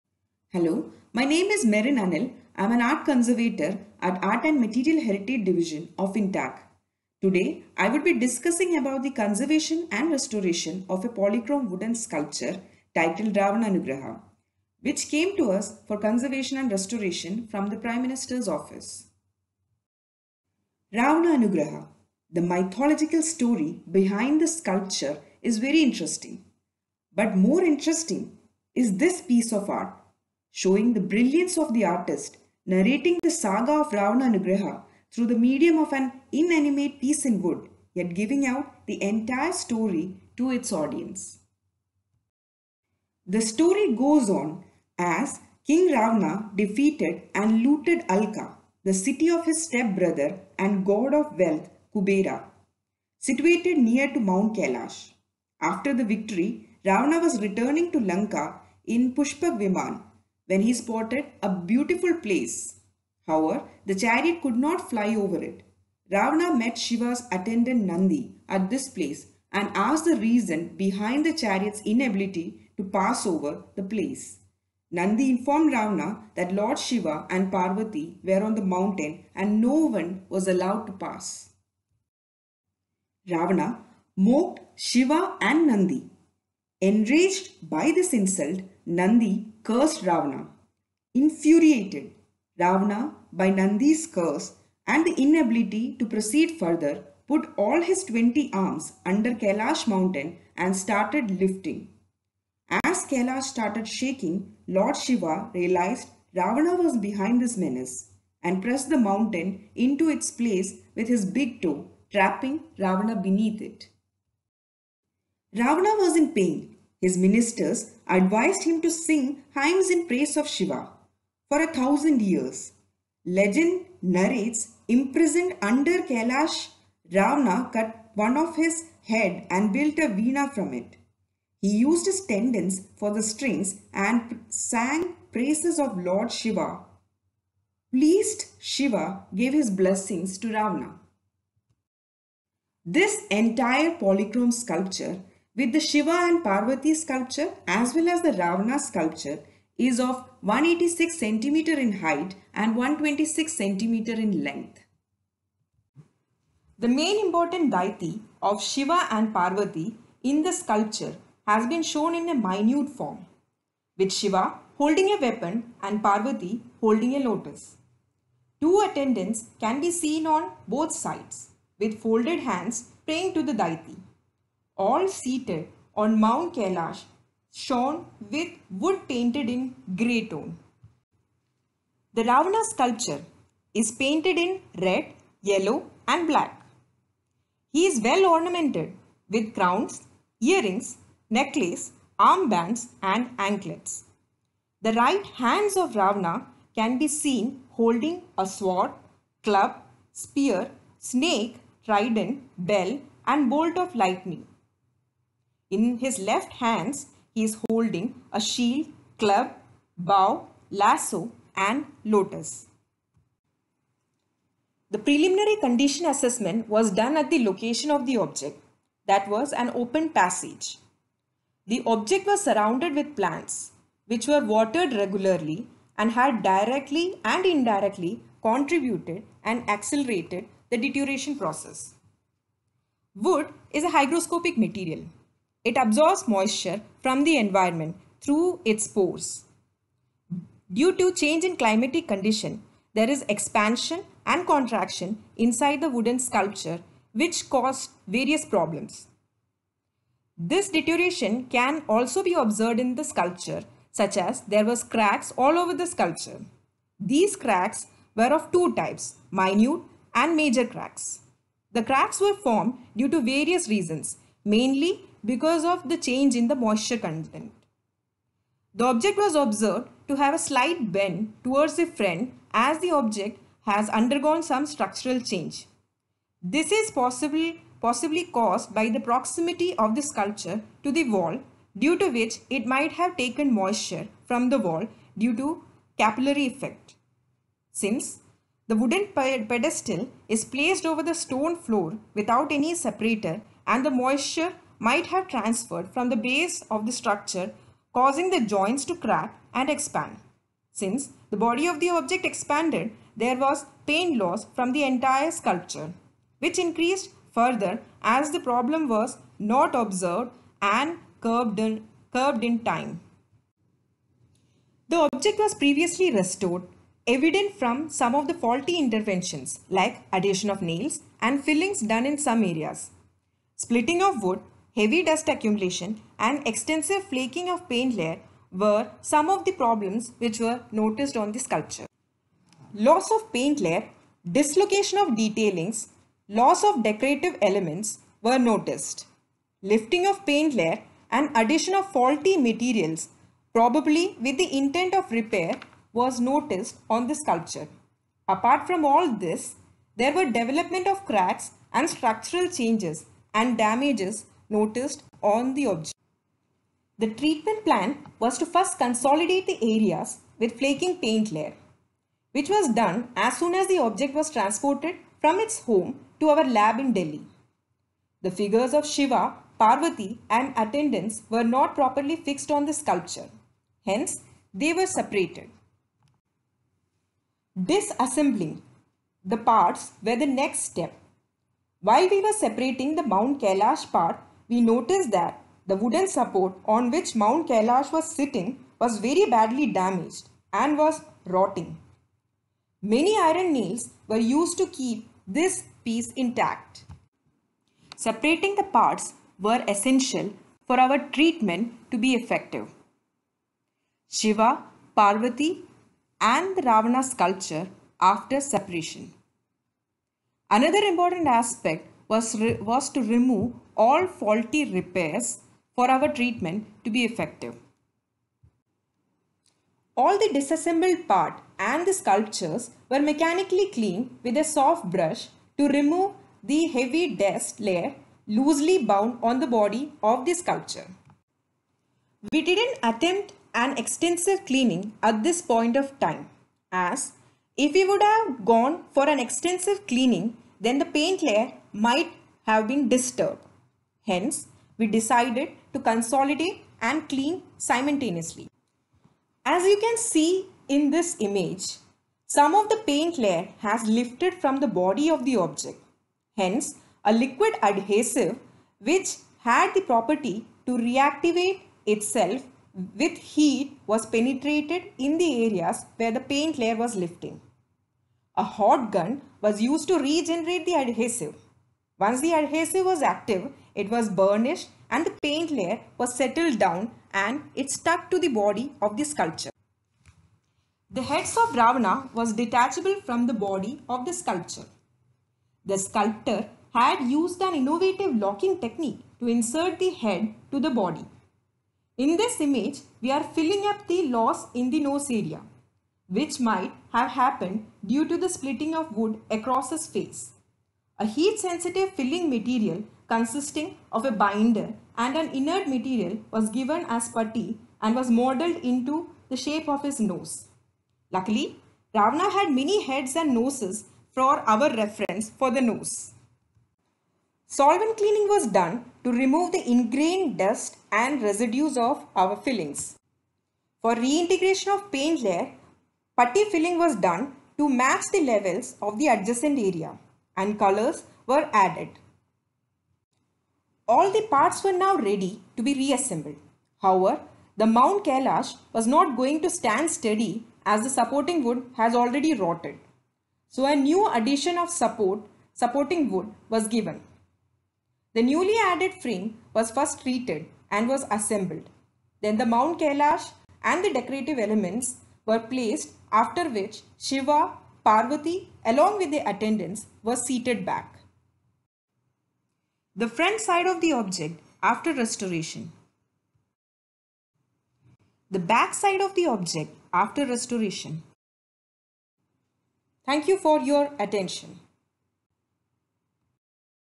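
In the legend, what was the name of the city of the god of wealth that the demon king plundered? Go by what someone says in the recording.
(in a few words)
Alka.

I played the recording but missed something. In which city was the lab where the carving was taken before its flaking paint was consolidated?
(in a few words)
Delhi.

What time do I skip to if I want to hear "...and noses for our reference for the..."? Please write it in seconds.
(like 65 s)
513 s.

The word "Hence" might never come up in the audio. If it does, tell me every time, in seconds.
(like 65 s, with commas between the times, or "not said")
373 s, 444 s, 456 s.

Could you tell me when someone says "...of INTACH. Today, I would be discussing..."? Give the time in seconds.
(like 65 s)
5 s.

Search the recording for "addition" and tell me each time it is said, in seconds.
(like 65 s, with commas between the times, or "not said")
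320 s, 341 s, 544 s.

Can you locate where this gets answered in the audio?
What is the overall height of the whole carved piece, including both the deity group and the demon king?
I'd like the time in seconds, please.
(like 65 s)
150 s.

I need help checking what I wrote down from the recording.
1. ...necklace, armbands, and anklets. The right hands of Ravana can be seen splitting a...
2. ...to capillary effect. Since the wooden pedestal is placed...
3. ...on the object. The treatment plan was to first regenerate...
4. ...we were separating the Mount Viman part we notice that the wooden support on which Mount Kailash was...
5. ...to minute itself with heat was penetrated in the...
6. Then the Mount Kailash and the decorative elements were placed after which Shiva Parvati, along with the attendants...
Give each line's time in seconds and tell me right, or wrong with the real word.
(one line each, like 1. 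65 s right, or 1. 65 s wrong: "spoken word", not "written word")
1. 191 s wrong: "holding", not "splitting"
2. 285 s right
3. 355 s wrong: "consolidate", not "regenerate"
4. 382 s wrong: "Kailash", not "Viman"
5. 460 s wrong: "reactivate", not "minute"
6. 552 s right.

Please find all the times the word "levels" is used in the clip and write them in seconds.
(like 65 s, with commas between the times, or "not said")
528 s.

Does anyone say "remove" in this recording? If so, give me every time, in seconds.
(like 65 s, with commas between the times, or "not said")
413 s, 425 s, 519 s.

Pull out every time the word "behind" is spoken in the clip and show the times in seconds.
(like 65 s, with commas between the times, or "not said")
23 s, 70 s, 106 s.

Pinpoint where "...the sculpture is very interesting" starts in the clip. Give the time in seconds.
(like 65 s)
24 s.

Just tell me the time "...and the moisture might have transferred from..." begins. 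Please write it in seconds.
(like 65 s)
293 s.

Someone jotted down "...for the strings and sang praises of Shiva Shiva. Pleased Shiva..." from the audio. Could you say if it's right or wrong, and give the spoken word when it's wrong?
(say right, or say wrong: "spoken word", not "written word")
wrong: "Lord", not "Shiva".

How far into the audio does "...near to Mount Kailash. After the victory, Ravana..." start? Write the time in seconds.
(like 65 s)
53 s.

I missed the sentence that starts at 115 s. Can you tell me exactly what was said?
Ravana was in pain his ministers advised him to sing hymns in praise of Shiva for a thousand years.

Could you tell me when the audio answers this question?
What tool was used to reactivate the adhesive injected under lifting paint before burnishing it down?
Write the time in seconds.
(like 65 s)
468 s.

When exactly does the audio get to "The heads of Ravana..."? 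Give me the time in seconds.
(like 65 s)
480 s.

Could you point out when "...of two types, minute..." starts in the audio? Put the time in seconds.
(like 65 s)
258 s.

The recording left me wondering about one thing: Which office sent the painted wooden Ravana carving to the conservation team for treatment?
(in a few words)
Prime Minister's office.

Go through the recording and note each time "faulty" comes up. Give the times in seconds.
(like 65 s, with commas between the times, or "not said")
318 s, 341 s, 414 s.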